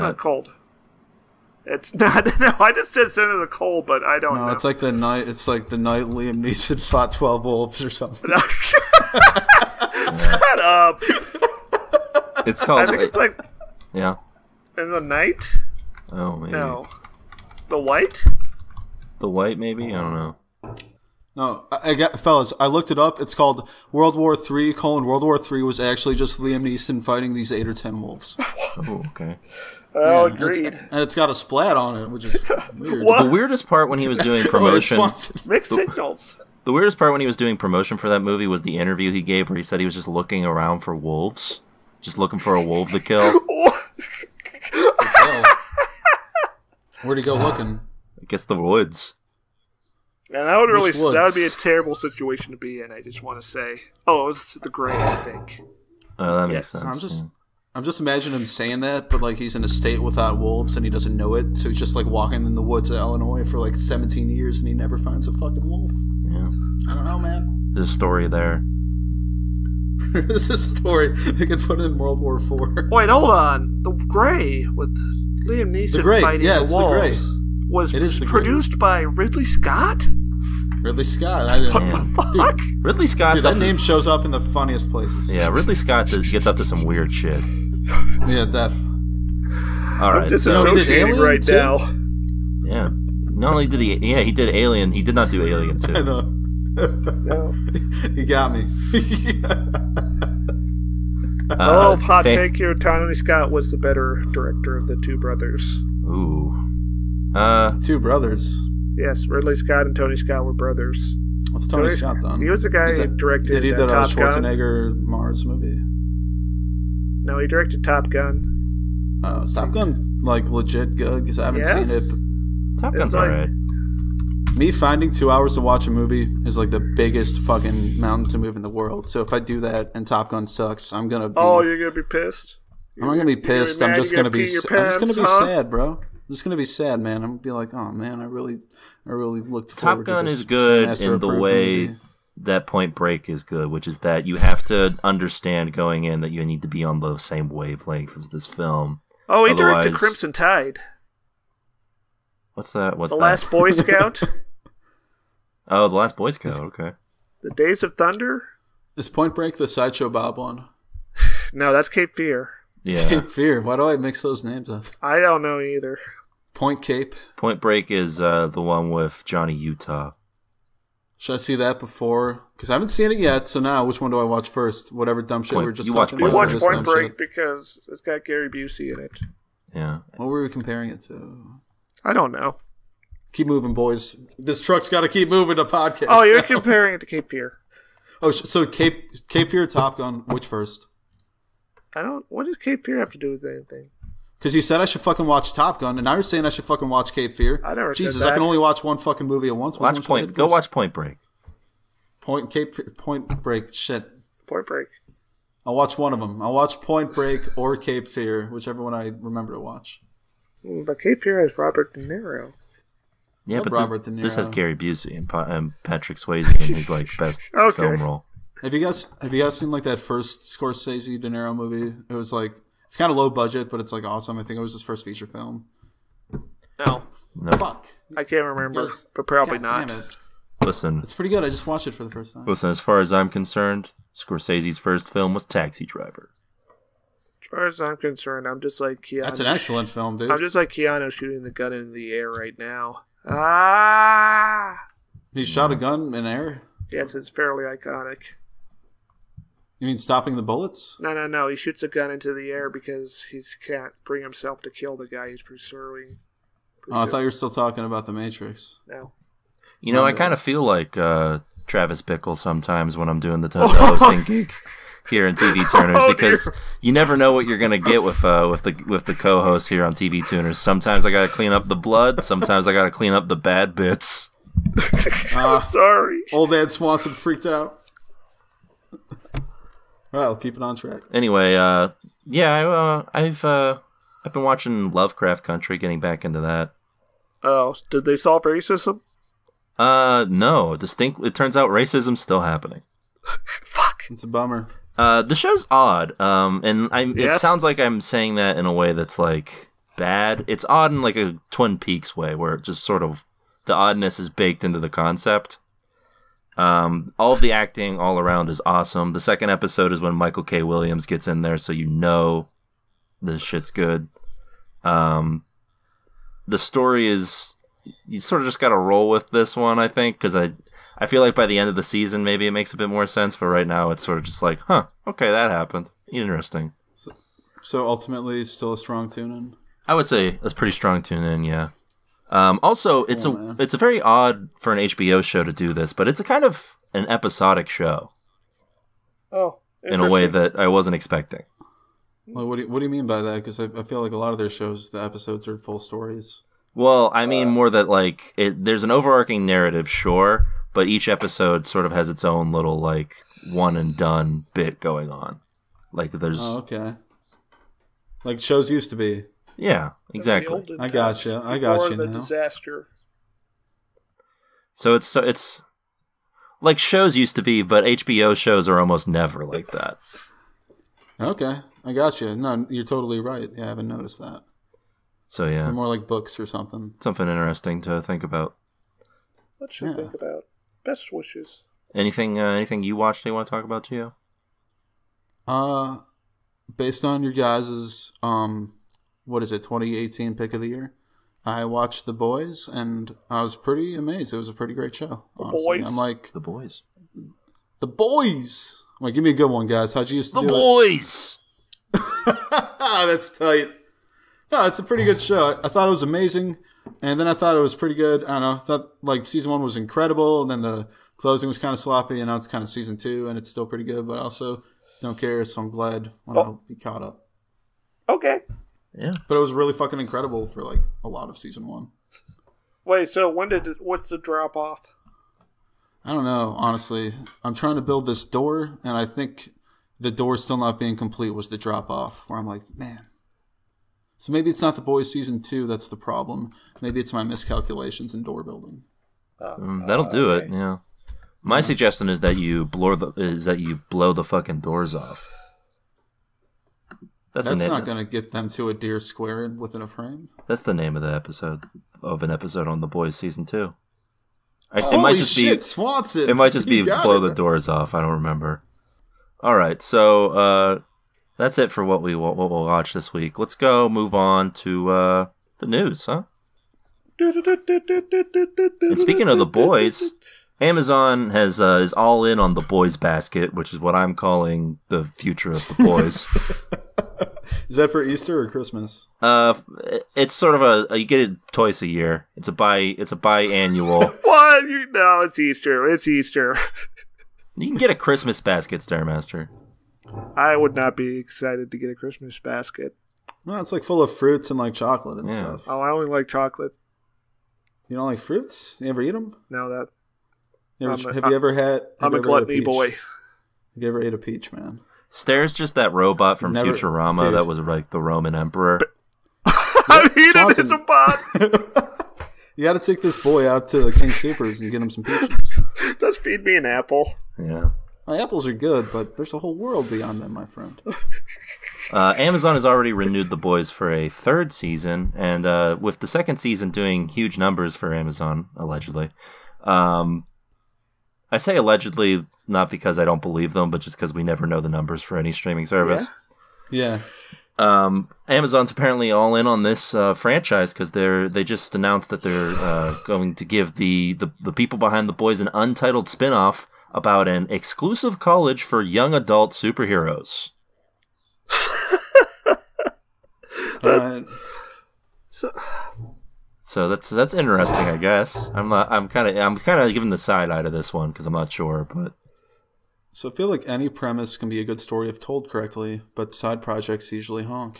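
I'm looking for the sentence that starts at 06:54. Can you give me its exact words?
But I also don't care, so I'm glad when oh.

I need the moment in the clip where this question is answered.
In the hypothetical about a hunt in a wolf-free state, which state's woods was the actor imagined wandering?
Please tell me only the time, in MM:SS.
01:02.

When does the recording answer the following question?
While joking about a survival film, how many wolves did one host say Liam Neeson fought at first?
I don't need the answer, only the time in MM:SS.
00:07.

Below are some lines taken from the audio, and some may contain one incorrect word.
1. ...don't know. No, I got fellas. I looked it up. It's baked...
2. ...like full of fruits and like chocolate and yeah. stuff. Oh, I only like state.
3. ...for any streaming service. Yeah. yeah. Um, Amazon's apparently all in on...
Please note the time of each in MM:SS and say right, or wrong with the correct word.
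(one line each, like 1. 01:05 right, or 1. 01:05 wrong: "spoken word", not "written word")
1. 00:20 wrong: "called", not "baked"
2. 08:13 wrong: "chocolate", not "state"
3. 08:55 right.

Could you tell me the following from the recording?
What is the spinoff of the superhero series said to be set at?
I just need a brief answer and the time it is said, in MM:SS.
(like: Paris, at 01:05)
An exclusive college, at 09:07.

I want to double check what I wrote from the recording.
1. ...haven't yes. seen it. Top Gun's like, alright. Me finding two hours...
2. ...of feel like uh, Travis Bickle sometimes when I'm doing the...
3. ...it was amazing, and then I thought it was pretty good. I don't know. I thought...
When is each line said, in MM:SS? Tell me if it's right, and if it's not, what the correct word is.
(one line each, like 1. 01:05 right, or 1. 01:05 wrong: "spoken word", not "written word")
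1. 02:01 right
2. 04:20 right
3. 06:45 right.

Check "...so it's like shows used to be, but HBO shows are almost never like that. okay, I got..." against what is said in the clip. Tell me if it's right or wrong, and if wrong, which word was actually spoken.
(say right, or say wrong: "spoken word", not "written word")
right.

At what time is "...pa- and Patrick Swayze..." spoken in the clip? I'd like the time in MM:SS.
03:35.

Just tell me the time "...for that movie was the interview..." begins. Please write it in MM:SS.
00:37.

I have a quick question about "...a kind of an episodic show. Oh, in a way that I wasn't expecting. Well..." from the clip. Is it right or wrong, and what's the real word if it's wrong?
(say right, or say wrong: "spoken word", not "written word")
right.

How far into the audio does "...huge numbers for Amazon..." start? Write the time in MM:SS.
08:47.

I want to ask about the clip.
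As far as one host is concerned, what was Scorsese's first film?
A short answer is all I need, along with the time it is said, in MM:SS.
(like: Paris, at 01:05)
Taxi Driver, at 03:55.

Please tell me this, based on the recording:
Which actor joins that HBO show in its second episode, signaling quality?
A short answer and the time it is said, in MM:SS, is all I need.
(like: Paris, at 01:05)
Michael K. Williams, at 05:10.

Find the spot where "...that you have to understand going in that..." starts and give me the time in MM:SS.
02:23.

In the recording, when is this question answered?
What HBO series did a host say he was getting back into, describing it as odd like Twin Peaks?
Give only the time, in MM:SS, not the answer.
04:44.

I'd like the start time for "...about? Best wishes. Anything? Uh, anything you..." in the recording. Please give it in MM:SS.
06:20.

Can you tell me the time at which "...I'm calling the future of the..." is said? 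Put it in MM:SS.
07:53.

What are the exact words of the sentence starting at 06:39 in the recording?
How'd you used to the do Boys?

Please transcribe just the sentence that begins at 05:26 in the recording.
So, so ultimately, still a strong tune in.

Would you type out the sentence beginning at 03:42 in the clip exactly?
It was like it's kind of low budget, but it's like awesome.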